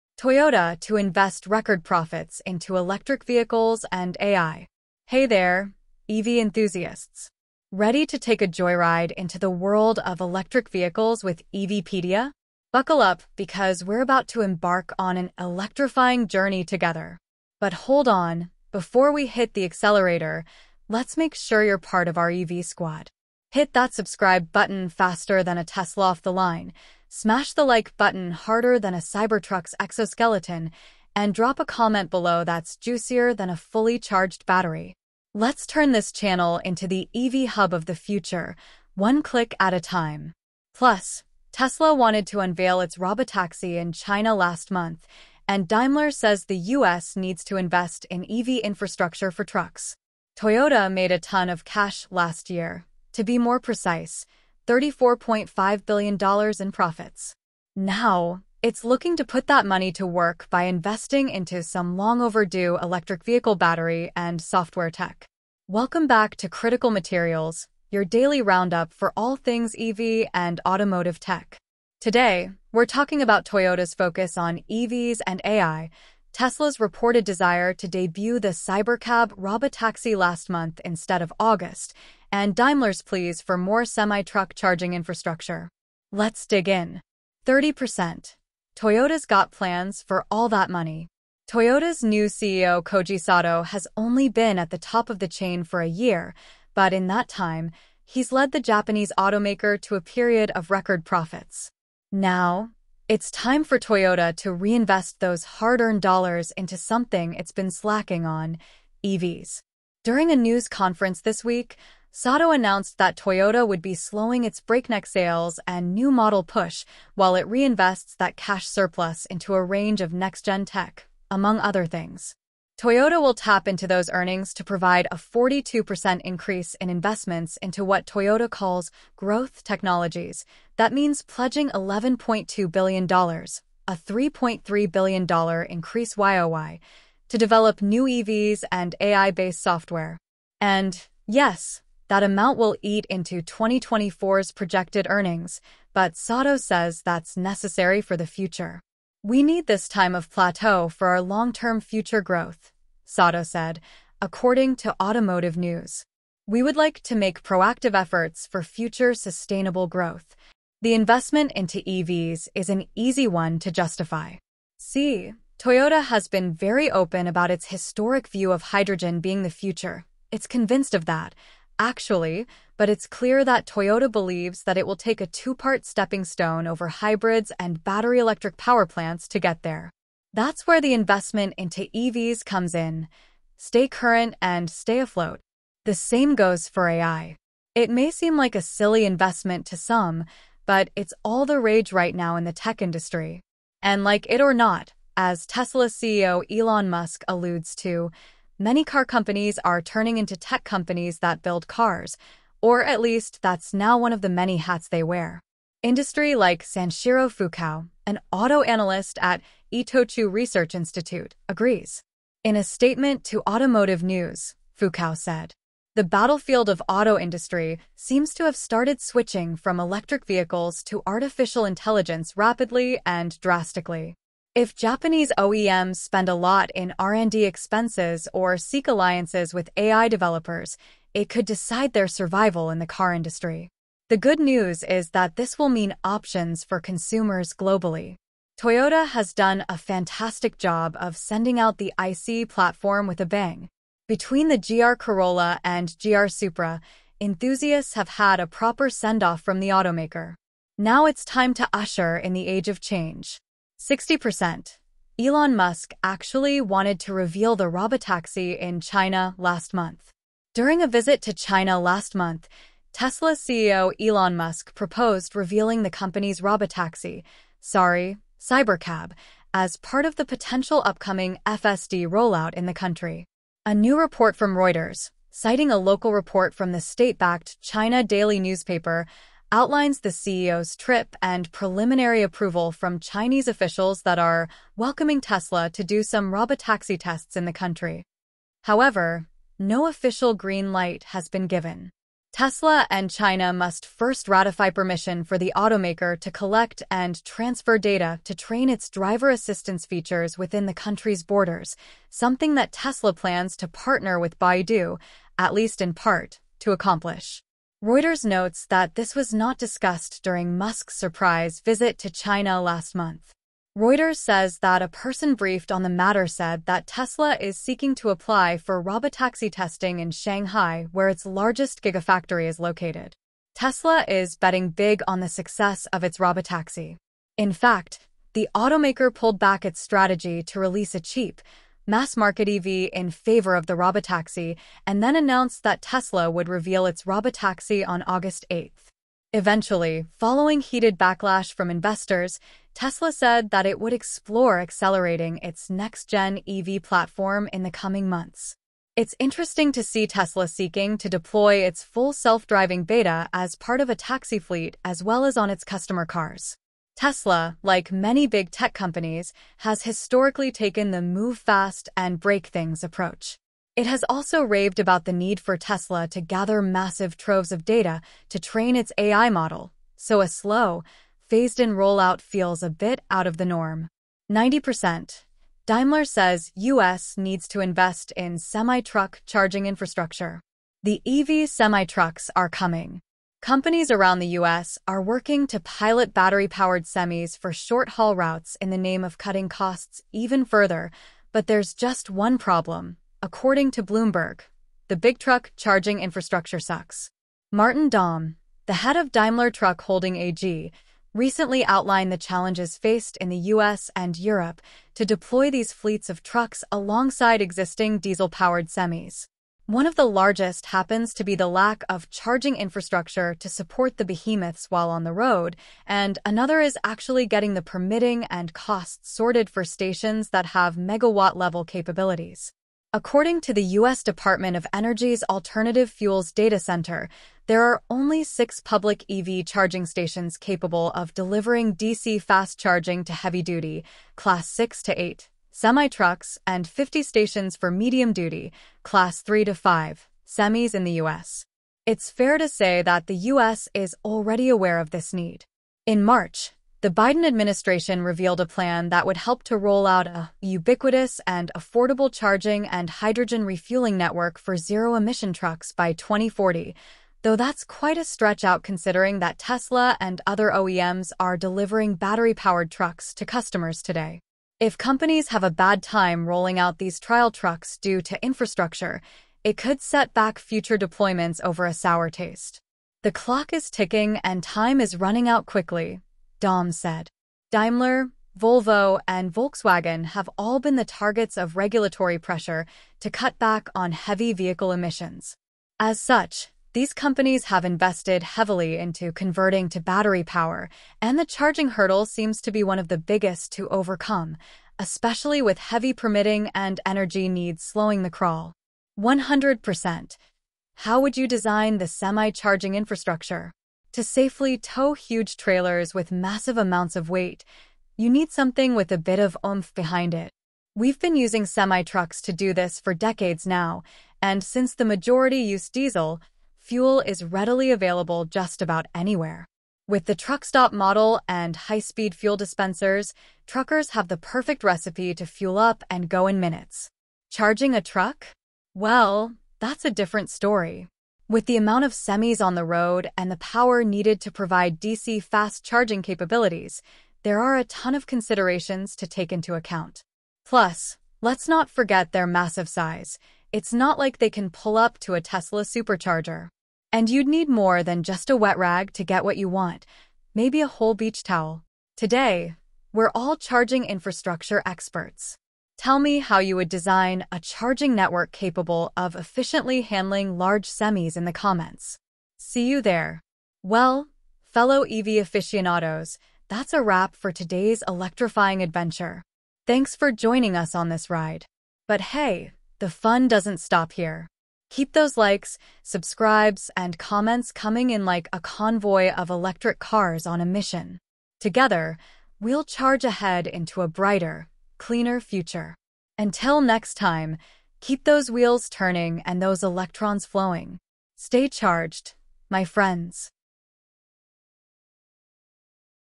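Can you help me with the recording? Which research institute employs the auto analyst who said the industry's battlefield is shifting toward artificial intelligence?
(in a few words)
Itochu Research Institute.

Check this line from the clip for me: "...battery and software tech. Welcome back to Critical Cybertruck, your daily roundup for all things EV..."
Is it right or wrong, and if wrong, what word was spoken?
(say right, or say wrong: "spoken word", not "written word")
wrong: "Materials", not "Cybertruck".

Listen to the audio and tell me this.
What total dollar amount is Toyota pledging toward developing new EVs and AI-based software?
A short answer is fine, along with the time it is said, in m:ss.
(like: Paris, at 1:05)
$11.2 billion, at 2:11.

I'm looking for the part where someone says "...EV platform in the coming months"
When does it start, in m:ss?
5:46.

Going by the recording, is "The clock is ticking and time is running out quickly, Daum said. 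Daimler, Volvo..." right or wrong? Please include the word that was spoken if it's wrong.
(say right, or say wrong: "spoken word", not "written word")
right.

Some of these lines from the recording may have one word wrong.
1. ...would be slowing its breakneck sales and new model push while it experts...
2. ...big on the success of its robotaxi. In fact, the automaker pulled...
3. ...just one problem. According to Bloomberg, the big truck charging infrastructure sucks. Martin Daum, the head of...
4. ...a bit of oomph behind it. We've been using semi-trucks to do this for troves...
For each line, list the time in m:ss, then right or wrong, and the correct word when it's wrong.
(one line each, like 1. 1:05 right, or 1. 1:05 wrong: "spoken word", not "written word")
1. 1:53 wrong: "reinvests", not "experts"
2. 5:24 right
3. 6:31 right
4. 8:28 wrong: "decades", not "troves".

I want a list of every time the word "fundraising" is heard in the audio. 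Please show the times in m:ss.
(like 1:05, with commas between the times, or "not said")
not said.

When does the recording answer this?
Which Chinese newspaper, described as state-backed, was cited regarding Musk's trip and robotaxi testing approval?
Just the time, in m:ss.
4:37.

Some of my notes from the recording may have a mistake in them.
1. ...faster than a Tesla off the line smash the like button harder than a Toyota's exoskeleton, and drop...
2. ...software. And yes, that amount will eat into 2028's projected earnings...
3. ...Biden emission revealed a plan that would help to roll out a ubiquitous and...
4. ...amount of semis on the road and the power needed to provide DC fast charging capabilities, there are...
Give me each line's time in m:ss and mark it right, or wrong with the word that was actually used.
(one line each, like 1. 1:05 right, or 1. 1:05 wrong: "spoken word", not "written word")
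1. 0:24 wrong: "Cybertruck", not "Toyota"
2. 2:19 wrong: "2024", not "2028"
3. 7:26 wrong: "administration", not "emission"
4. 8:51 right.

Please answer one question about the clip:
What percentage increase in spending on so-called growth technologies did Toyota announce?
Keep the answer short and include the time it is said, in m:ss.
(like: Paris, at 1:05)
42%, at 2:05.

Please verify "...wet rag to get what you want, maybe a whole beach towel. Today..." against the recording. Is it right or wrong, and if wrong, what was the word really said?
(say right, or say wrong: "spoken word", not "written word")
right.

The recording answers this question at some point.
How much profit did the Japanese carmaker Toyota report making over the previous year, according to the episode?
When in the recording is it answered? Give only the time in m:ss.
0:54.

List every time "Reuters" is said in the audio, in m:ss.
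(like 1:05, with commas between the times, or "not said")
4:34, 5:07, 5:13.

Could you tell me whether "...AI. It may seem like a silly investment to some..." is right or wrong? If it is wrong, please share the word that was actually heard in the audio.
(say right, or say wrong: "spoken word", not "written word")
right.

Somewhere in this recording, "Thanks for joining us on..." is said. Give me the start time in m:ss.
9:29.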